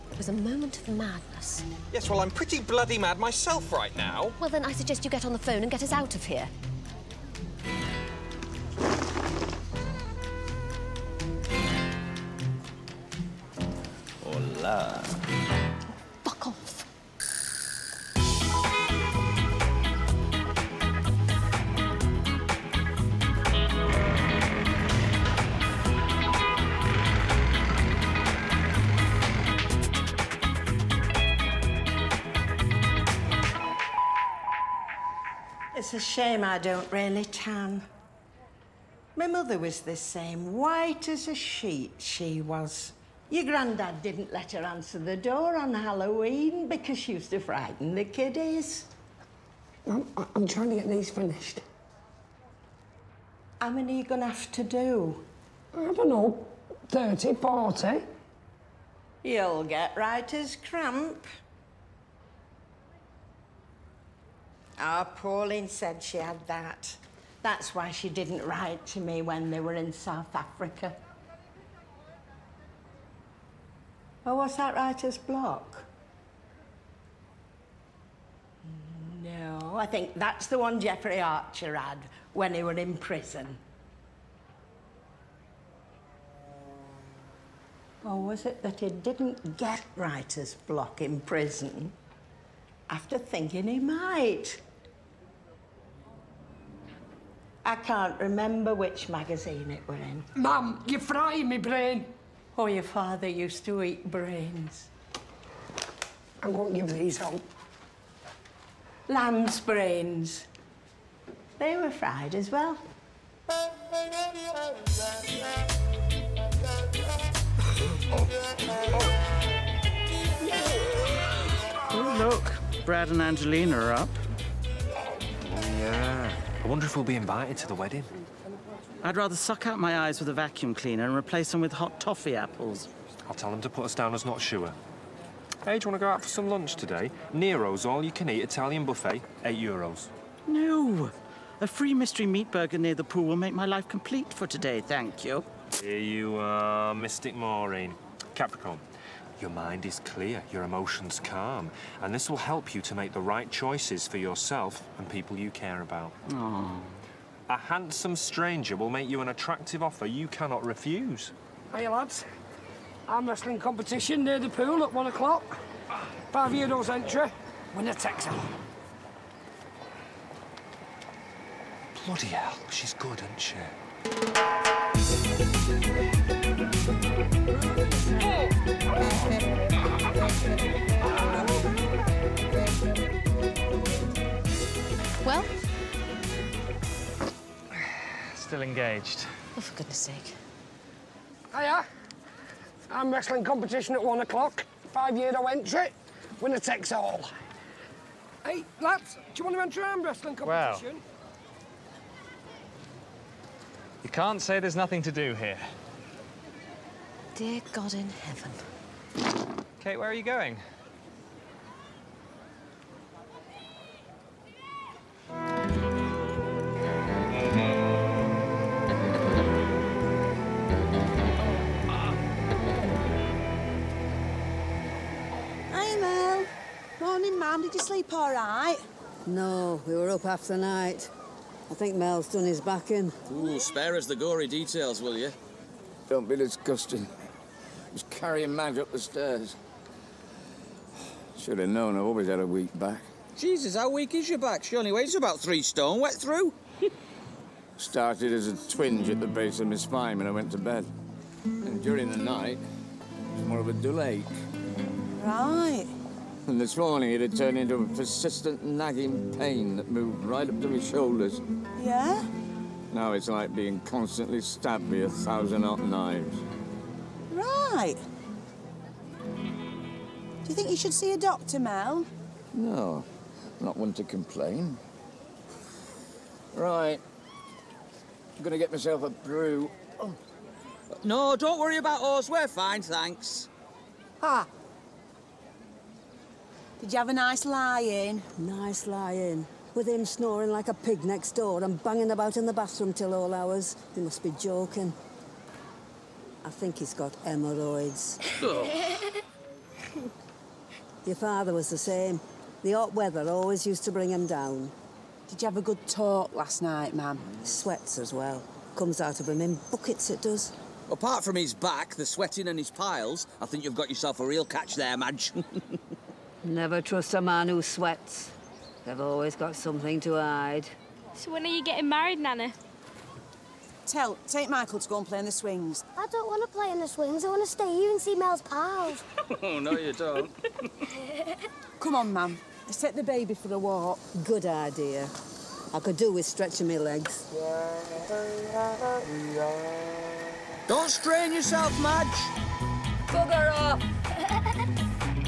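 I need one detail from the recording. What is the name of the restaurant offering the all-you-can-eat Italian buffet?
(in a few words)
Nero's.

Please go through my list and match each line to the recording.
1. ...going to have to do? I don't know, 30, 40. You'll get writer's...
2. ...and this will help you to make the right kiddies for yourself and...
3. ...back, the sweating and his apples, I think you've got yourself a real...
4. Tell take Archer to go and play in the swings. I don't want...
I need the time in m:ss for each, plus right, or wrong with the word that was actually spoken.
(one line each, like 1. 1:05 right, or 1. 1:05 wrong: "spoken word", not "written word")
1. 0:54 right
2. 2:32 wrong: "choices", not "kiddies"
3. 5:11 wrong: "piles", not "apples"
4. 5:23 wrong: "Michael", not "Archer".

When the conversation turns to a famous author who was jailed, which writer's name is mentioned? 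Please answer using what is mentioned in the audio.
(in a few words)
Jeffrey Archer.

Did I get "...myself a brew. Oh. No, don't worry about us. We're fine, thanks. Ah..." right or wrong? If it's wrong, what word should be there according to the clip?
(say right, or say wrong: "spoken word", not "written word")
right.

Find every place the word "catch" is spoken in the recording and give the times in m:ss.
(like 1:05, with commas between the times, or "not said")
5:14.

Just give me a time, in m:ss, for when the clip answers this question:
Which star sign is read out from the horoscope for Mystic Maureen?
2:28.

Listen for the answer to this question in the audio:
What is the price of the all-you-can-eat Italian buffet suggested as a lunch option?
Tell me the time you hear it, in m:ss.
2:19.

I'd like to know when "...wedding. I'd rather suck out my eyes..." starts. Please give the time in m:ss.
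2:07.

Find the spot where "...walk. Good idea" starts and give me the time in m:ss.
5:33.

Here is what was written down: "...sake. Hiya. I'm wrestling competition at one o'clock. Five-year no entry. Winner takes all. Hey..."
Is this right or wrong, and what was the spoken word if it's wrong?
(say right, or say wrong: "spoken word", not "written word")
right.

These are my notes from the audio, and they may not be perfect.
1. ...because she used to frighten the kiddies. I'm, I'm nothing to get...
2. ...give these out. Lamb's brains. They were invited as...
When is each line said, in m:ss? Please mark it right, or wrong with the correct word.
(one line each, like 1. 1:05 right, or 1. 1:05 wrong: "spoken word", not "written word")
1. 0:46 wrong: "trying", not "nothing"
2. 1:46 wrong: "fried", not "invited".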